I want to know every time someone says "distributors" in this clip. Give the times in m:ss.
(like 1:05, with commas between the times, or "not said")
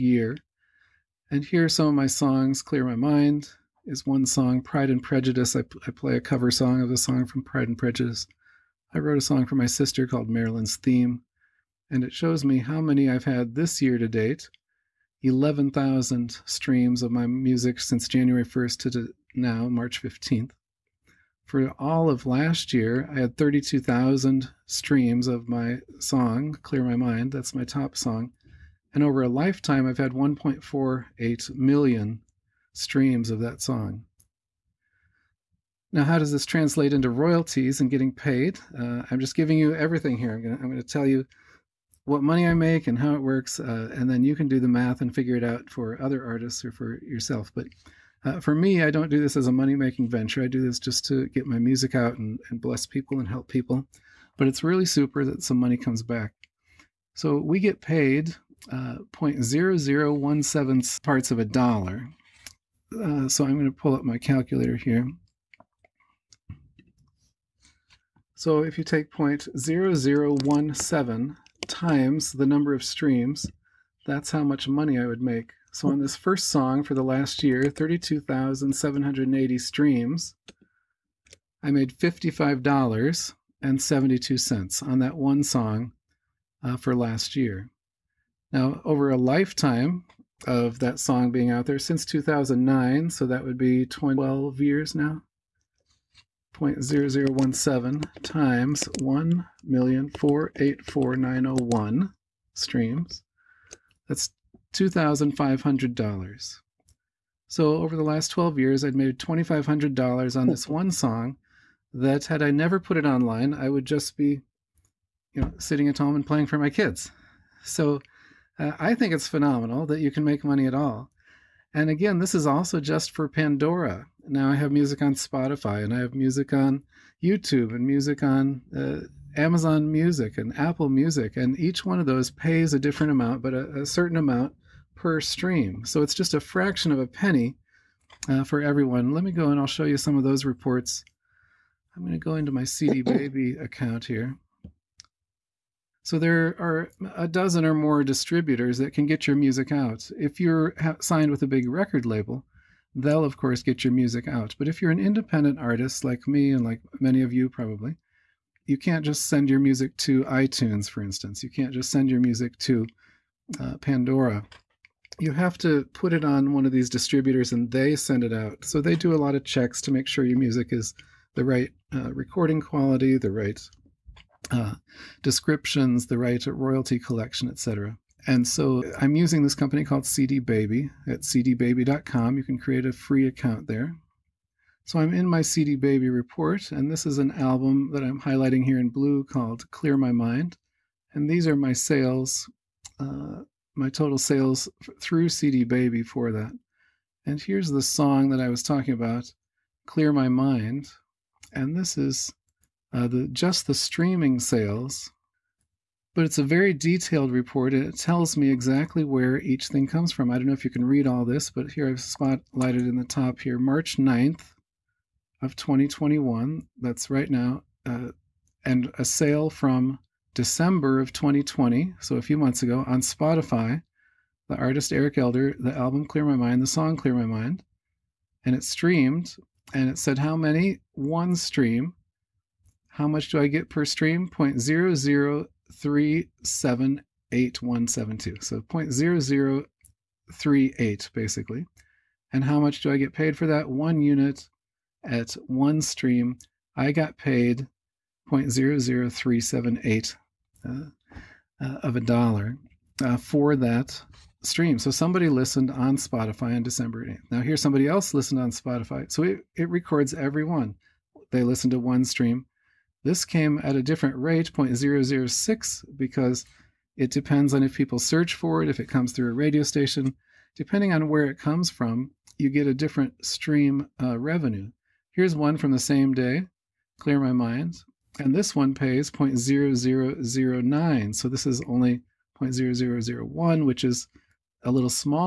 2:28, 2:46.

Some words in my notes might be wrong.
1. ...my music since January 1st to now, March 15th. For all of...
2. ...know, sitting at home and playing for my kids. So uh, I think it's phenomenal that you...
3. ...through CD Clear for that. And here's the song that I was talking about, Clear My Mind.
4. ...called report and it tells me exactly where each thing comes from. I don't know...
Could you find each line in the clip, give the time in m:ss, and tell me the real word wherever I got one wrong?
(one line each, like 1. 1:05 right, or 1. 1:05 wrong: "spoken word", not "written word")
1. 0:17 right
2. 1:55 right
3. 3:14 wrong: "Baby", not "Clear"
4. 3:26 wrong: "detailed", not "called".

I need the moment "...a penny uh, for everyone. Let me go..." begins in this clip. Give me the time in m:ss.
2:16.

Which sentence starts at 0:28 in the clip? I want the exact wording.
And over a lifetime, I've had 1.48 million streams of that song.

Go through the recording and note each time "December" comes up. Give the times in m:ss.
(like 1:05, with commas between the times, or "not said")
3:40, 4:16.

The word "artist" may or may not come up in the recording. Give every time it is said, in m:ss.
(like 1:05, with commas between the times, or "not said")
0:46, 2:35, 3:44.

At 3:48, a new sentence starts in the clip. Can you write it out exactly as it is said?
And it streamed and it said how many?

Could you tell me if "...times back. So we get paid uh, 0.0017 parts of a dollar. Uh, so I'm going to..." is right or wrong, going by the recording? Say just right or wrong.
wrong.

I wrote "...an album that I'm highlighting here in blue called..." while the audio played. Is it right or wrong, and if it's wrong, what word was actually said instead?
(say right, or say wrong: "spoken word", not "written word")
right.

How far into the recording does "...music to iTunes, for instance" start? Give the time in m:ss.
2:39.